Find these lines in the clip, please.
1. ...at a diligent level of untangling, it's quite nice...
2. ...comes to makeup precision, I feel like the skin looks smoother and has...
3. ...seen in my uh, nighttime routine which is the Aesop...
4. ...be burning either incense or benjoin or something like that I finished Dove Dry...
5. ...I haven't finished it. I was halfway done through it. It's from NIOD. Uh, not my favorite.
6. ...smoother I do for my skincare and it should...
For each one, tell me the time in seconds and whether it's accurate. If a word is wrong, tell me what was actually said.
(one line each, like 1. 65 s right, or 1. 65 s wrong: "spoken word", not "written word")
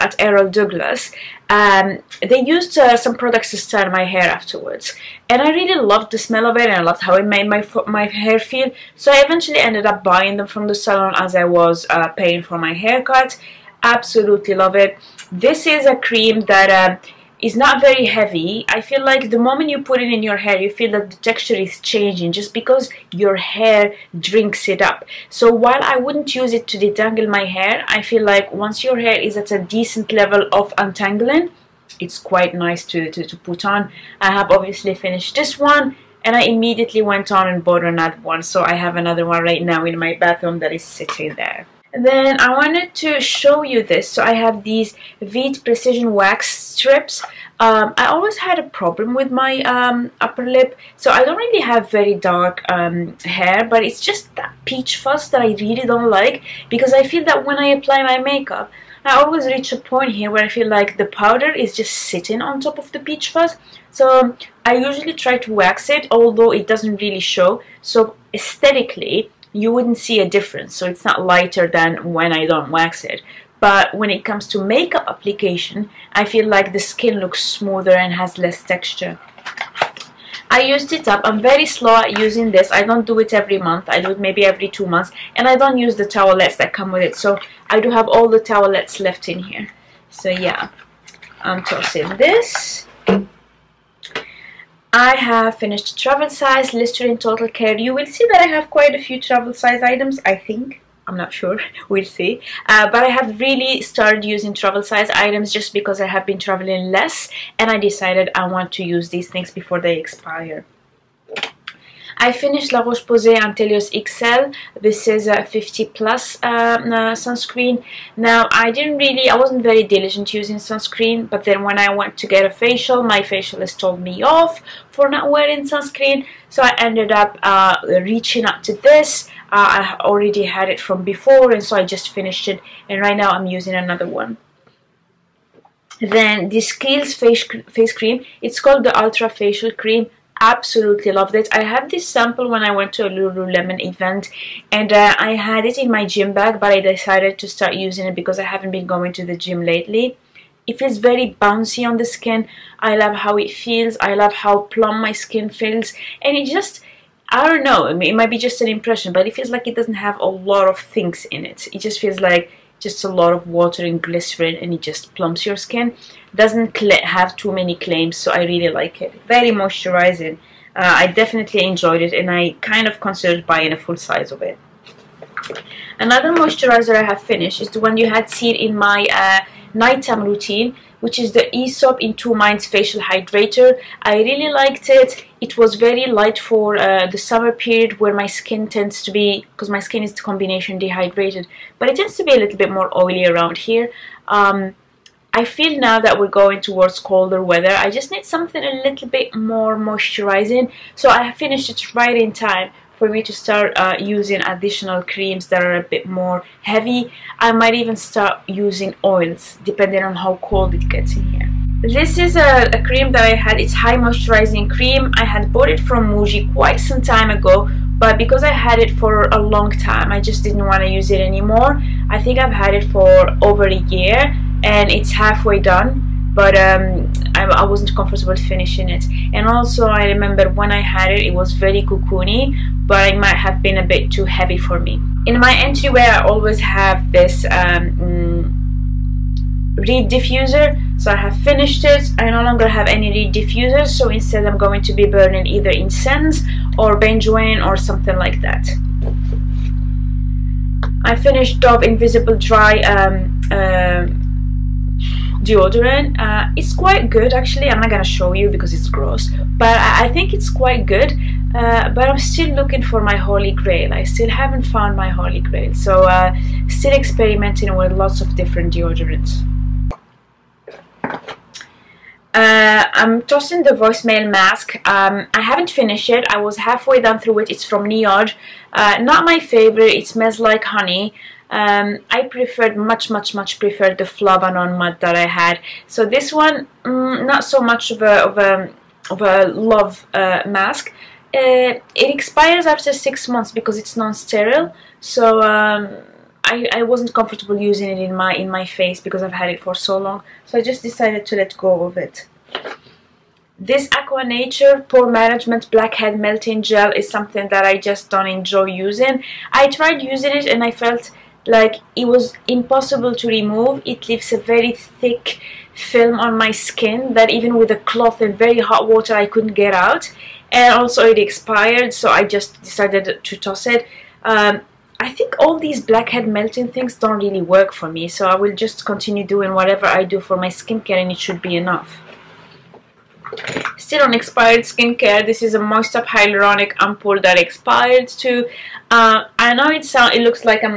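1. 29 s wrong: "decent", not "diligent"
2. 74 s wrong: "application", not "precision"
3. 178 s right
4. 244 s wrong: "Invisible", not "Dry"
5. 275 s right
6. 329 s wrong: "whatever", not "smoother".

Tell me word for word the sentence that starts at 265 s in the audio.
So uh, still experimenting with lots of different deodorants.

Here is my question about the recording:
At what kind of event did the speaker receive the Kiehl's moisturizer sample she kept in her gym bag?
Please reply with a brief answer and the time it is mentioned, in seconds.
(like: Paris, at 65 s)
Lululemon event, at 143 s.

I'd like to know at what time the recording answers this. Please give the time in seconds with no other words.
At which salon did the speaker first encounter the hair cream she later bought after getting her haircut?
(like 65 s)
0 s.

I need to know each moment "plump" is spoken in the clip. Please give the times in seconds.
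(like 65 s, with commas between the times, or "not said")
154 s, 165 s.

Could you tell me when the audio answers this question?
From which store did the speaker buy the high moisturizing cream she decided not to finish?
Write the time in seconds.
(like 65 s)
216 s.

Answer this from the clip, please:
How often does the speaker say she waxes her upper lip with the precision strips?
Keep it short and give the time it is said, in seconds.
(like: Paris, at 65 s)
every 2 months, at 84 s.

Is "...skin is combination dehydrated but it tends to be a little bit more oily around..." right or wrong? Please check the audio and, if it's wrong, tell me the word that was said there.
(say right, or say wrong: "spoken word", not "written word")
right.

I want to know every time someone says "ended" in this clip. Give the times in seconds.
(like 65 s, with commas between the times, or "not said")
9 s, 126 s.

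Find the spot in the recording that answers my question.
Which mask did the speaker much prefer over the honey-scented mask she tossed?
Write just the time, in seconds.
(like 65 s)
284 s.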